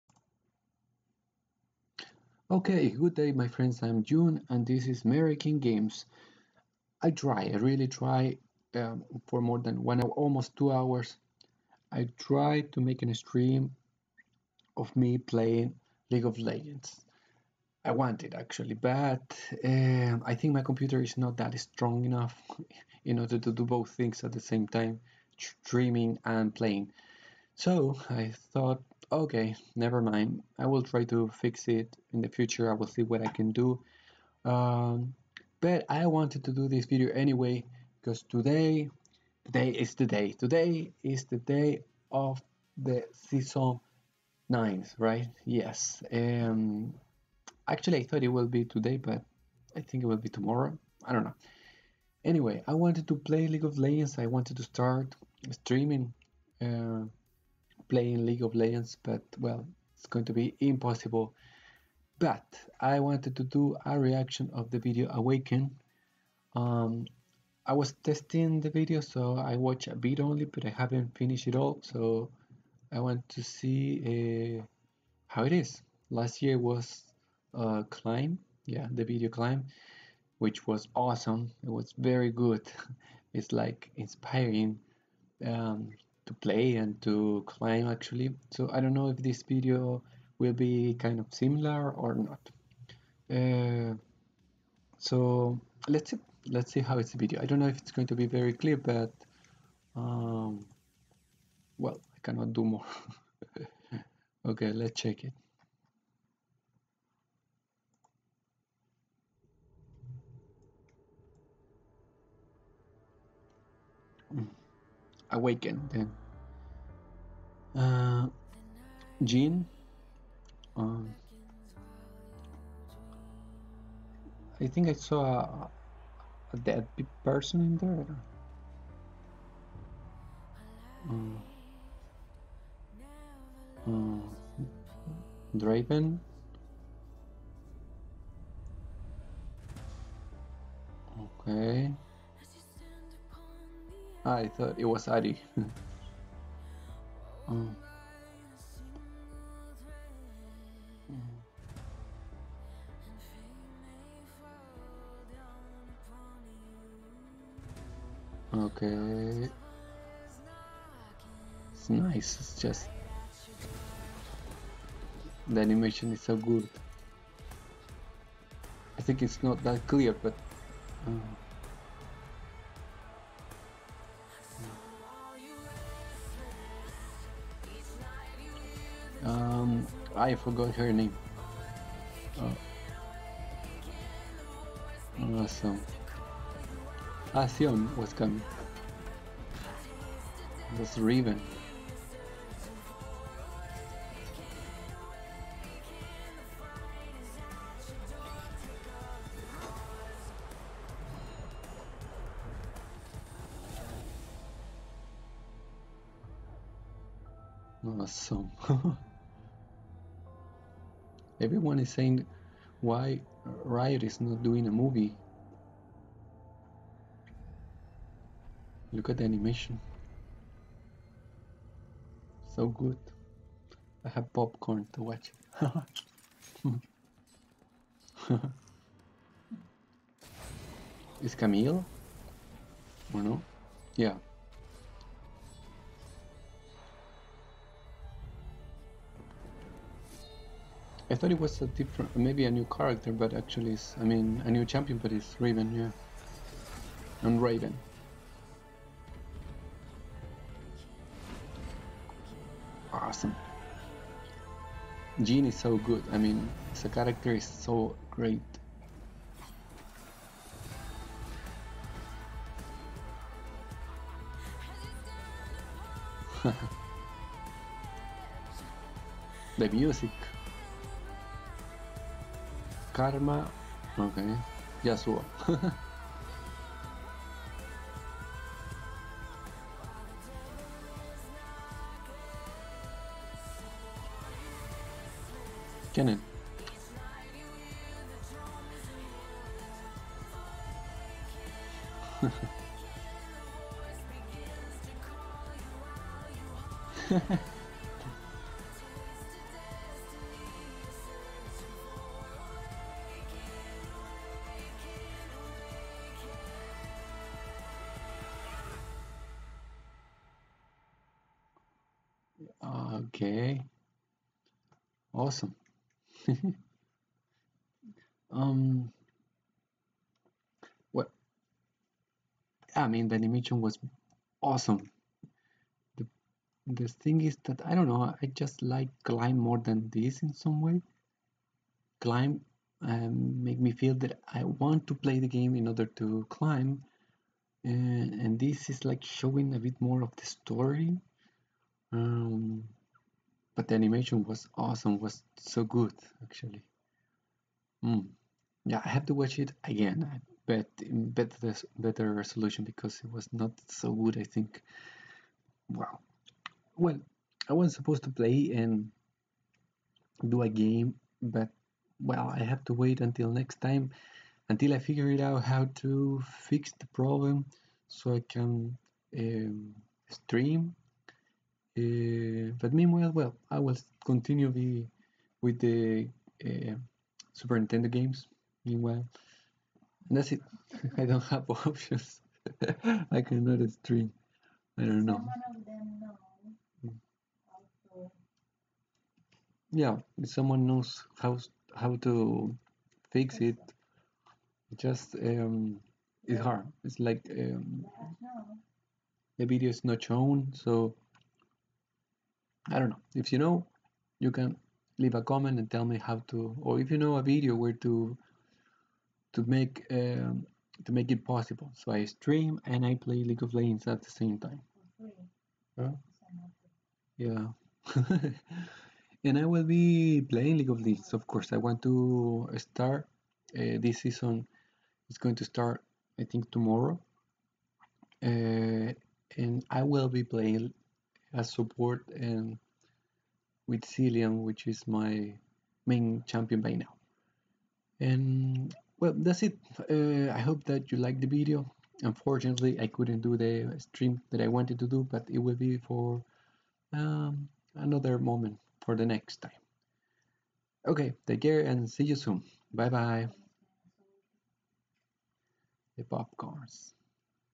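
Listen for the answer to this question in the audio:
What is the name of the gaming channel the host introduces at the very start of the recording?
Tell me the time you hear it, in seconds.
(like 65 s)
5 s.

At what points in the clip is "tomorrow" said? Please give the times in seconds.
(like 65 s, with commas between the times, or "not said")
50 s, 426 s.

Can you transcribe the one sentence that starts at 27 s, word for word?
So I thought okay, never mind.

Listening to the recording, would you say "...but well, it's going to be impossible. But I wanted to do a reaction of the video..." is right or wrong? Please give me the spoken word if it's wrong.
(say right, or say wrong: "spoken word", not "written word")
right.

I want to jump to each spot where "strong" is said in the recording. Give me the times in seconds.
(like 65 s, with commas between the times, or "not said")
21 s.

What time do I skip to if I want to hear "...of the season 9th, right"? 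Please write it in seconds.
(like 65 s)
42 s.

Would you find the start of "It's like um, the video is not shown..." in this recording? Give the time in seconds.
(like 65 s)
396 s.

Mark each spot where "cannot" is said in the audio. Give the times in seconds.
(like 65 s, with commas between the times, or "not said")
102 s, 383 s.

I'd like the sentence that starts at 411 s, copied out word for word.
So I stream and I play League of Legends at the same time.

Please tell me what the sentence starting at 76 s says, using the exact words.
Last year was uh, Climb, yeah, the video Climb, which was awesome.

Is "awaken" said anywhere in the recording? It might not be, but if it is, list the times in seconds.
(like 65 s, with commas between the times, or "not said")
65 s, 115 s.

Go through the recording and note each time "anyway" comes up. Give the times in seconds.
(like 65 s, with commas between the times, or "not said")
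37 s, 52 s.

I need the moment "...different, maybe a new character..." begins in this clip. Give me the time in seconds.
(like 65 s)
241 s.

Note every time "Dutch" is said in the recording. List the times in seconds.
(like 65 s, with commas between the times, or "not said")
not said.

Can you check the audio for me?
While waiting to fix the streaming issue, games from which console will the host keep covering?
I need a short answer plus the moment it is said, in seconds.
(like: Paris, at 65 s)
Super Nintendo, at 377 s.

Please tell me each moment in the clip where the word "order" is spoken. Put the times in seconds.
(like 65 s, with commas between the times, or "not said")
23 s, 335 s.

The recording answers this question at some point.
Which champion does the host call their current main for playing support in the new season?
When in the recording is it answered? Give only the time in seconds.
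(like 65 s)
433 s.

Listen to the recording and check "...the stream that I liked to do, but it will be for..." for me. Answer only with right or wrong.
wrong.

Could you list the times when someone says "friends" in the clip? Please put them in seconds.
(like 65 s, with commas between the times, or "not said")
3 s.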